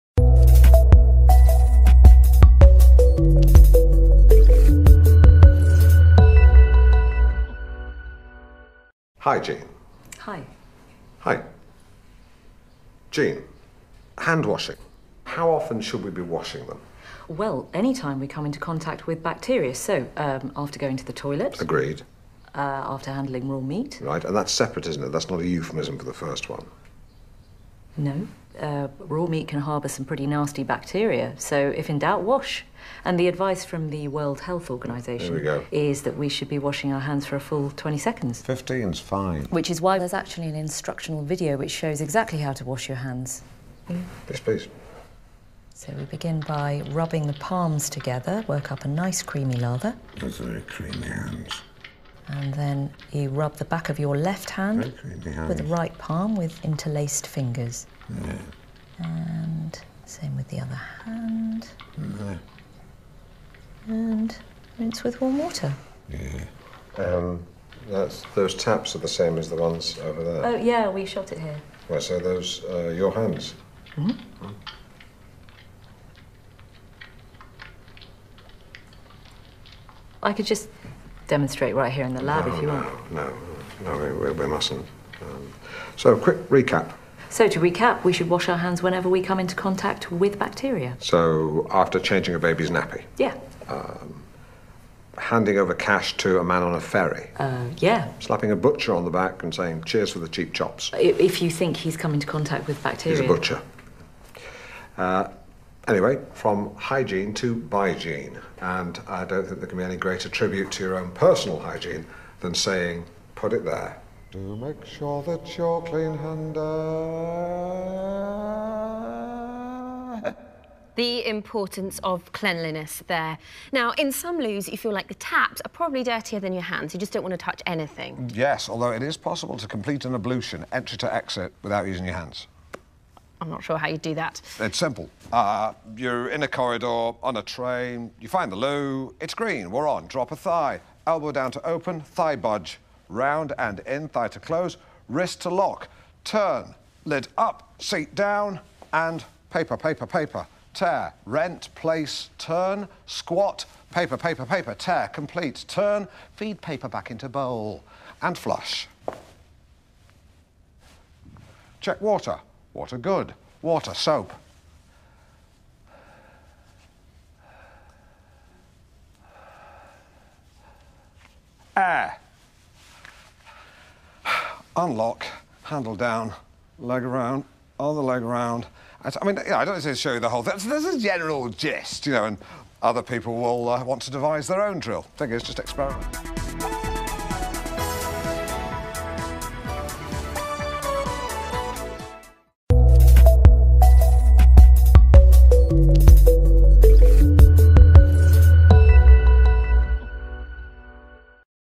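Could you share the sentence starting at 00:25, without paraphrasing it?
That's not a euphemism for the first one.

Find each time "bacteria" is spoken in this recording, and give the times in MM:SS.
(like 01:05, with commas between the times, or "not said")
00:19, 00:30, 01:30, 01:42.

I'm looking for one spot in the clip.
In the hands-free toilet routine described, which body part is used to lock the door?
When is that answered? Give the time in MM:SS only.
02:25.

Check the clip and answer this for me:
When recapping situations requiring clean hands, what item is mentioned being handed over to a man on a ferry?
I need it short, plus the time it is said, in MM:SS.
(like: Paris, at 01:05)
cash, at 01:35.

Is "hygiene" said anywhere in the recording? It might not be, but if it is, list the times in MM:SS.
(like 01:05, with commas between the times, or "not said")
01:46, 01:51.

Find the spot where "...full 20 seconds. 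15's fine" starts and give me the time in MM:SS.
00:37.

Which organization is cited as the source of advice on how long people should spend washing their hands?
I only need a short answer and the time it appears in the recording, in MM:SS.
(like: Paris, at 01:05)
World Health Organization, at 00:34.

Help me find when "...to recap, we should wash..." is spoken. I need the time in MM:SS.
01:27.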